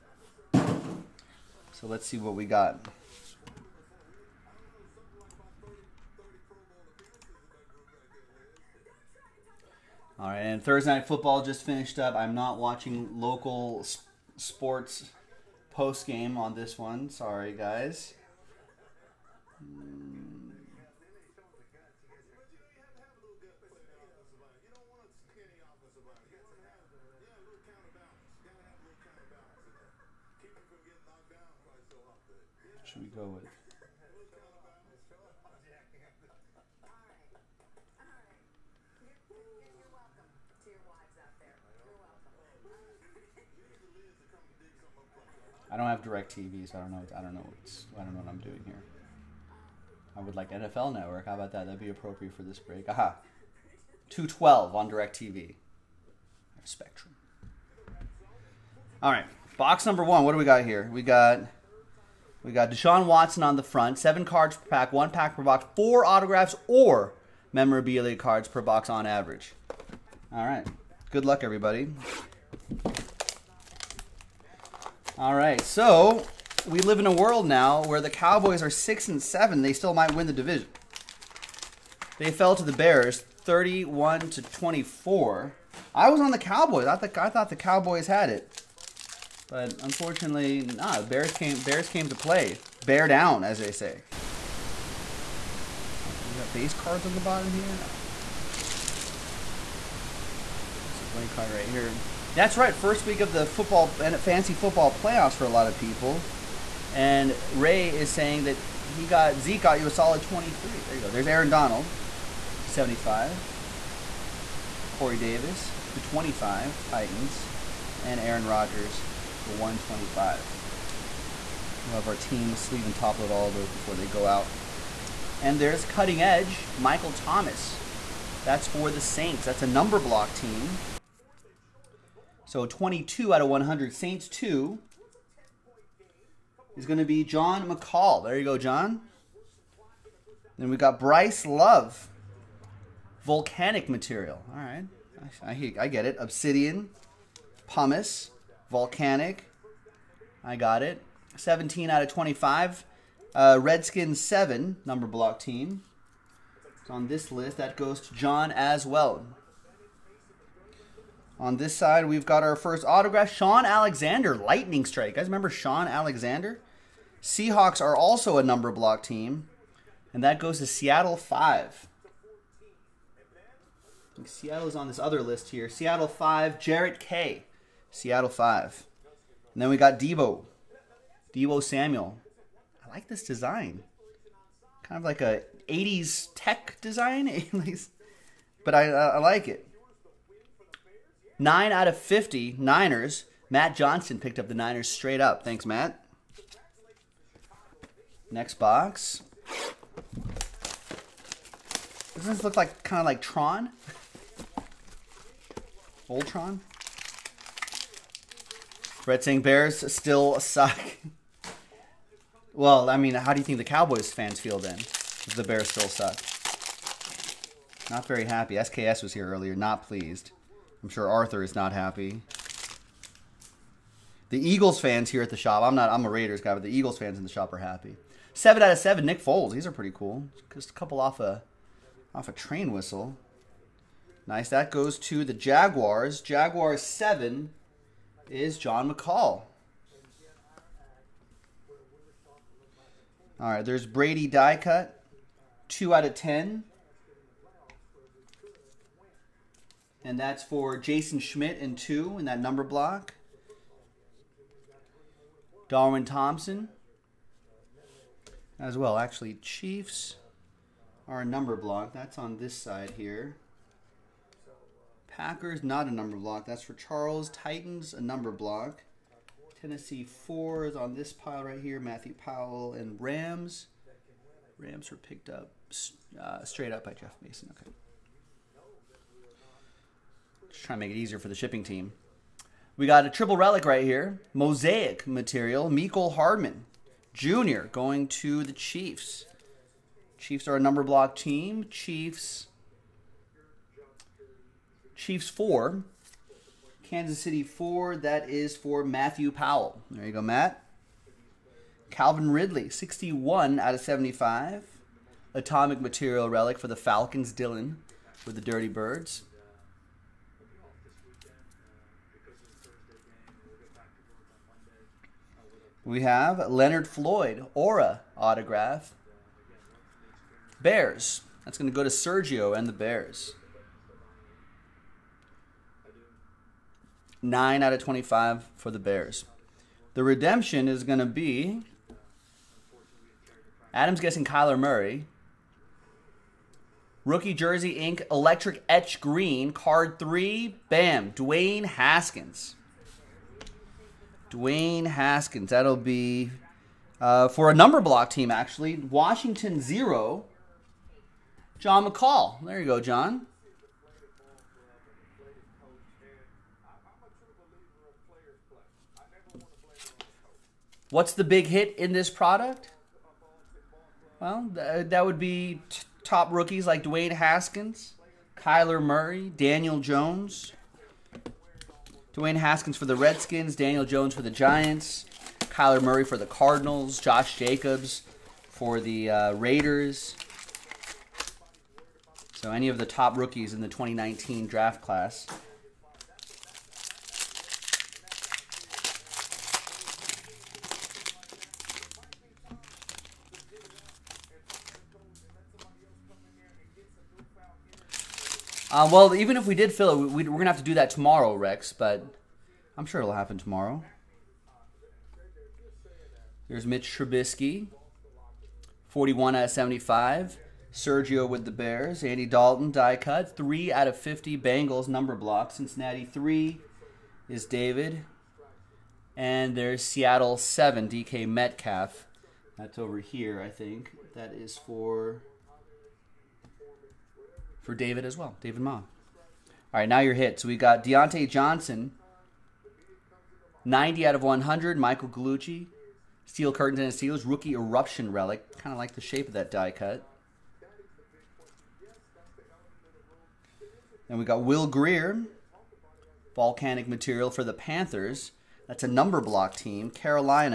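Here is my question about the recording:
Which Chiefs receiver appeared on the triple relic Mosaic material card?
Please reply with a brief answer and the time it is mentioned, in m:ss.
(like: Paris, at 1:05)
Mecole Hardman Jr., at 4:45.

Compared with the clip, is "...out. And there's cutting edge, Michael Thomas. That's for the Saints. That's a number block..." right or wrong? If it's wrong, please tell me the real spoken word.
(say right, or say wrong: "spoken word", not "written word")
right.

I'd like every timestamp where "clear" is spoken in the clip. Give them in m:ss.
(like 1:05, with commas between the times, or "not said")
not said.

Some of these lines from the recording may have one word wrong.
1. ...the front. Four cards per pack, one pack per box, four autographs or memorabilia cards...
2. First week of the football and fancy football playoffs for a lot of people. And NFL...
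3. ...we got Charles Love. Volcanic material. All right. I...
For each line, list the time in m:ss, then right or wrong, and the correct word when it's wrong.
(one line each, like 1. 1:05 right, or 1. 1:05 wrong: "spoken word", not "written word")
1. 1:03 wrong: "Seven", not "Four"
2. 1:42 wrong: "Ray", not "NFL"
3. 2:20 wrong: "Bryce", not "Charles".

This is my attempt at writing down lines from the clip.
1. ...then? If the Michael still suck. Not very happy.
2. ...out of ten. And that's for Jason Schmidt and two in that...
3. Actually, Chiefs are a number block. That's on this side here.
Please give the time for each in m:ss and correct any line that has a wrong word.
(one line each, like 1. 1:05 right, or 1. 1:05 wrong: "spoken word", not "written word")
1. 3:34 wrong: "Bears", not "Michael"
2. 4:05 right
3. 4:18 right.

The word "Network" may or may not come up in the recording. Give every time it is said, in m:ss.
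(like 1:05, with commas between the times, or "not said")
0:50.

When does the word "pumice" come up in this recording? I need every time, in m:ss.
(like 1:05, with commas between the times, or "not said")
2:27.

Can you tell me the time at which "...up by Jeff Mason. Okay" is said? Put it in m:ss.
4:36.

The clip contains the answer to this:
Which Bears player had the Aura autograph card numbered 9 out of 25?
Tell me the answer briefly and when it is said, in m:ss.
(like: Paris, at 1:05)
Leonard Floyd, at 5:16.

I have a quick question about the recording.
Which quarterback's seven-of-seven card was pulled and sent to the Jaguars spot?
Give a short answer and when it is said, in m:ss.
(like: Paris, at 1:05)
Nick Foles, at 3:49.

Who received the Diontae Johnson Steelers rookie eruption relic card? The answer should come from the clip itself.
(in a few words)
Michael Gallucci.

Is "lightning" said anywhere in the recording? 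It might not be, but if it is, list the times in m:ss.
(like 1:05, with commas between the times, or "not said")
2:44.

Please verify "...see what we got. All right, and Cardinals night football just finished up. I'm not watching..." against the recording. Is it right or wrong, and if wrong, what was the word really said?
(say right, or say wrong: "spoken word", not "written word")
wrong: "Thursday", not "Cardinals".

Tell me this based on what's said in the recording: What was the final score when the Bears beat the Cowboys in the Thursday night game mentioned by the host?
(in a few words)
31 to 24.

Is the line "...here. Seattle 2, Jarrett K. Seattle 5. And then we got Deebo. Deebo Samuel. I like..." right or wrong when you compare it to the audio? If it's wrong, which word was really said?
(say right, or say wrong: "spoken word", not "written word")
wrong: "5", not "2".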